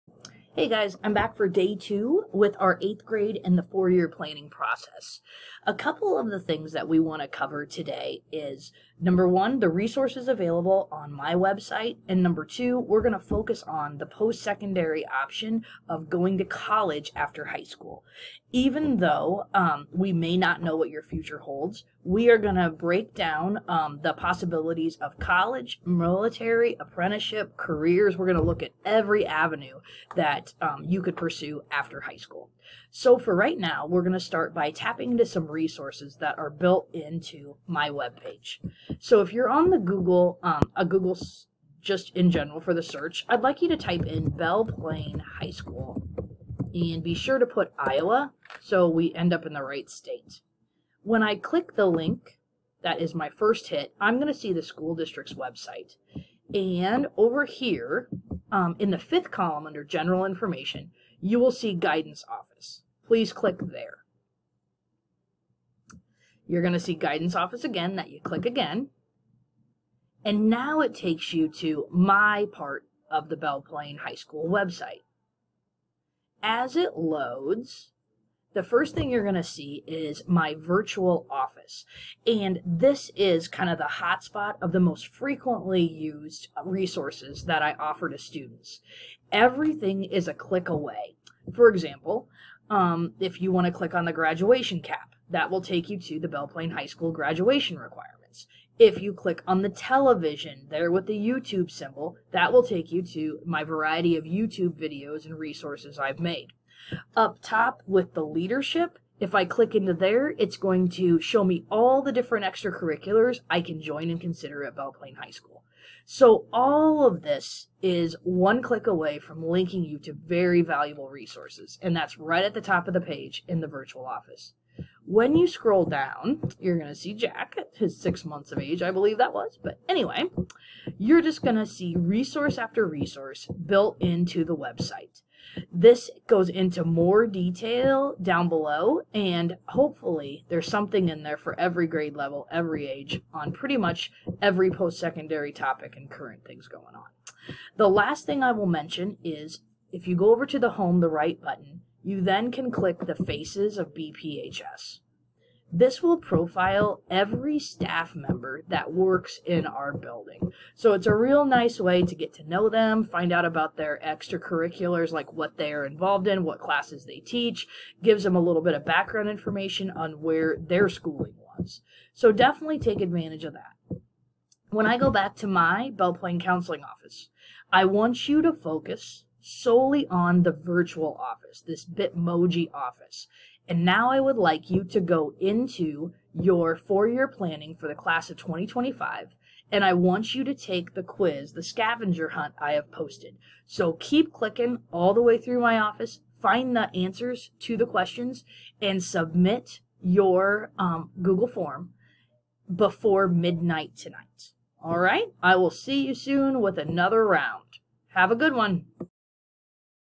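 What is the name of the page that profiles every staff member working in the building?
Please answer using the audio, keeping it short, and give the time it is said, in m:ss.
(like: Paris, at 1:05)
Faces of BPHS, at 2:33.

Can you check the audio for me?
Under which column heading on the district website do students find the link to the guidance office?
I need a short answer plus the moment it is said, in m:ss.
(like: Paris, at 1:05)
general information, at 0:59.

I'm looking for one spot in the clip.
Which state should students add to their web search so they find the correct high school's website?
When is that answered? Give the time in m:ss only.
0:47.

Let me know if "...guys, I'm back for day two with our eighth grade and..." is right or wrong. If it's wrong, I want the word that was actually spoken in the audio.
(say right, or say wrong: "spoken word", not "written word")
right.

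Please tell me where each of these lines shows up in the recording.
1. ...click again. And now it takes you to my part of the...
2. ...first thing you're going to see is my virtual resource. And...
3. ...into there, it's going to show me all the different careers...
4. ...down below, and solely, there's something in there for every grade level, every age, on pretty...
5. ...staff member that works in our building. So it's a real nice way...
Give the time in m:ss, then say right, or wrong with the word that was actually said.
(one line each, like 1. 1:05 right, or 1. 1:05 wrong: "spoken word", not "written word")
1. 1:08 right
2. 1:18 wrong: "office", not "resource"
3. 1:49 wrong: "extracurriculars", not "careers"
4. 2:18 wrong: "hopefully", not "solely"
5. 2:37 right.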